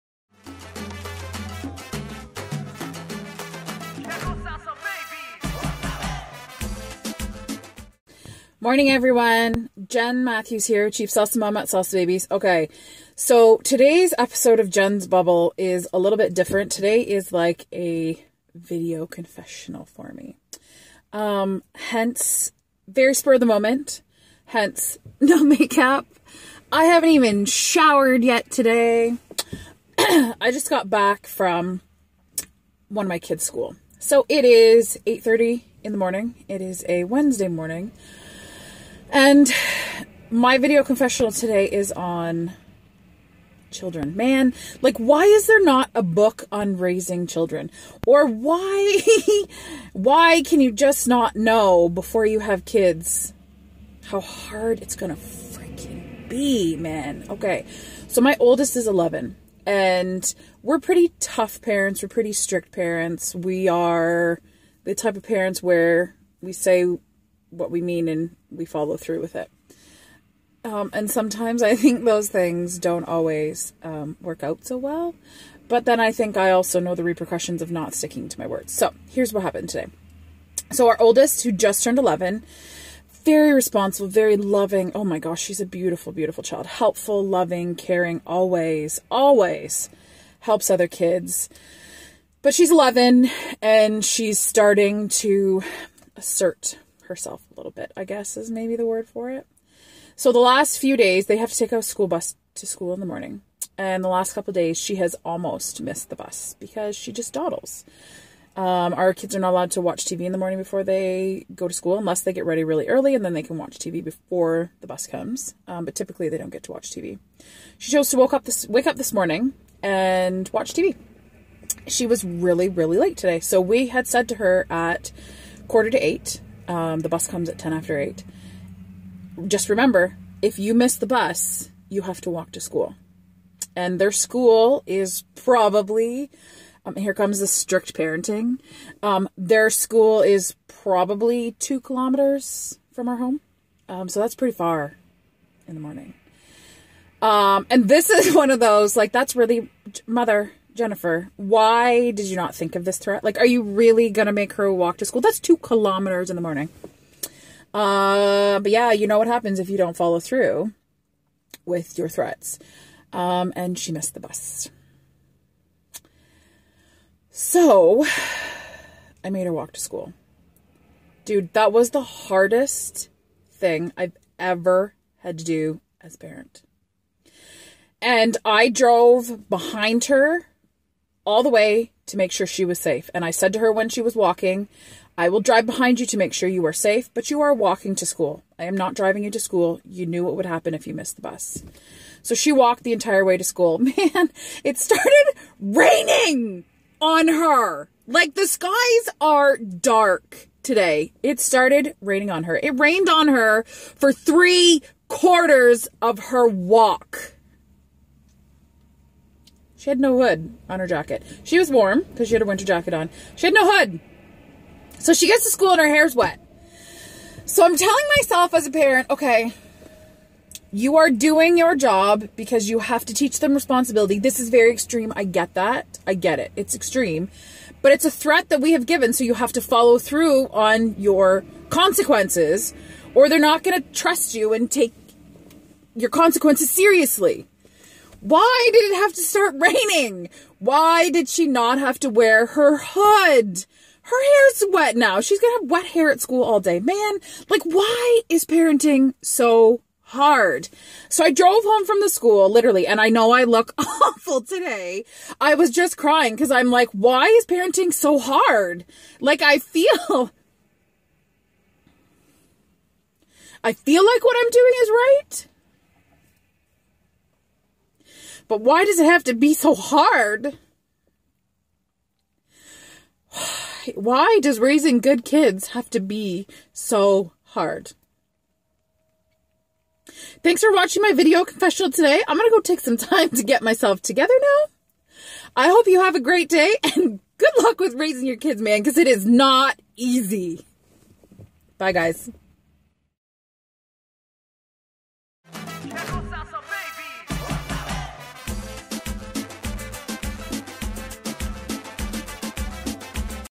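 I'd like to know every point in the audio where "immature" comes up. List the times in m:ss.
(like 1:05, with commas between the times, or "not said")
not said.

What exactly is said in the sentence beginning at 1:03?
We are the type of parents where we say what we mean and we follow through with it.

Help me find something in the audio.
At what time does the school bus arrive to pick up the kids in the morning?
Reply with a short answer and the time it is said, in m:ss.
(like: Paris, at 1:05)
10 after 8, at 2:07.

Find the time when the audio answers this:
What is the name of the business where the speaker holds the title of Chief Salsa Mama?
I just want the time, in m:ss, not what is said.
0:11.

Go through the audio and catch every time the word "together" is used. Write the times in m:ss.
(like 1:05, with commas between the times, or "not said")
4:44.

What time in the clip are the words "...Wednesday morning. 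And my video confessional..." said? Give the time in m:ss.
0:37.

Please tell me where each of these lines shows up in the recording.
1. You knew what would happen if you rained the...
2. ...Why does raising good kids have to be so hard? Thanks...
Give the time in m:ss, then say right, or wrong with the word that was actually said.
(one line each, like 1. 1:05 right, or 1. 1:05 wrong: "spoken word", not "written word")
1. 3:09 wrong: "missed", not "rained"
2. 4:33 right.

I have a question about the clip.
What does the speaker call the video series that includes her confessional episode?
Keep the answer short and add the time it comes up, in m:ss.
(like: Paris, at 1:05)
Jen's Bubble, at 0:14.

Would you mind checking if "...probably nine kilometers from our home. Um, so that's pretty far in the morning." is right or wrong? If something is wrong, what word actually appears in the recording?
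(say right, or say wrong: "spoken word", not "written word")
wrong: "two", not "nine".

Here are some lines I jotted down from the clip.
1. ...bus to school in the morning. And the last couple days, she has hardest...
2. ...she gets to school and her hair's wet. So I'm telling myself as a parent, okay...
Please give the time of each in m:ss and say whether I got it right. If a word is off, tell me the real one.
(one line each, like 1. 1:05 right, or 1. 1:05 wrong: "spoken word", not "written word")
1. 1:42 wrong: "almost", not "hardest"
2. 3:35 right.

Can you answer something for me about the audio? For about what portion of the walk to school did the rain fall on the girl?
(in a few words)
three quarters.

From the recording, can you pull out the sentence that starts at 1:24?
Oh my gosh, she's a beautiful, beautiful child.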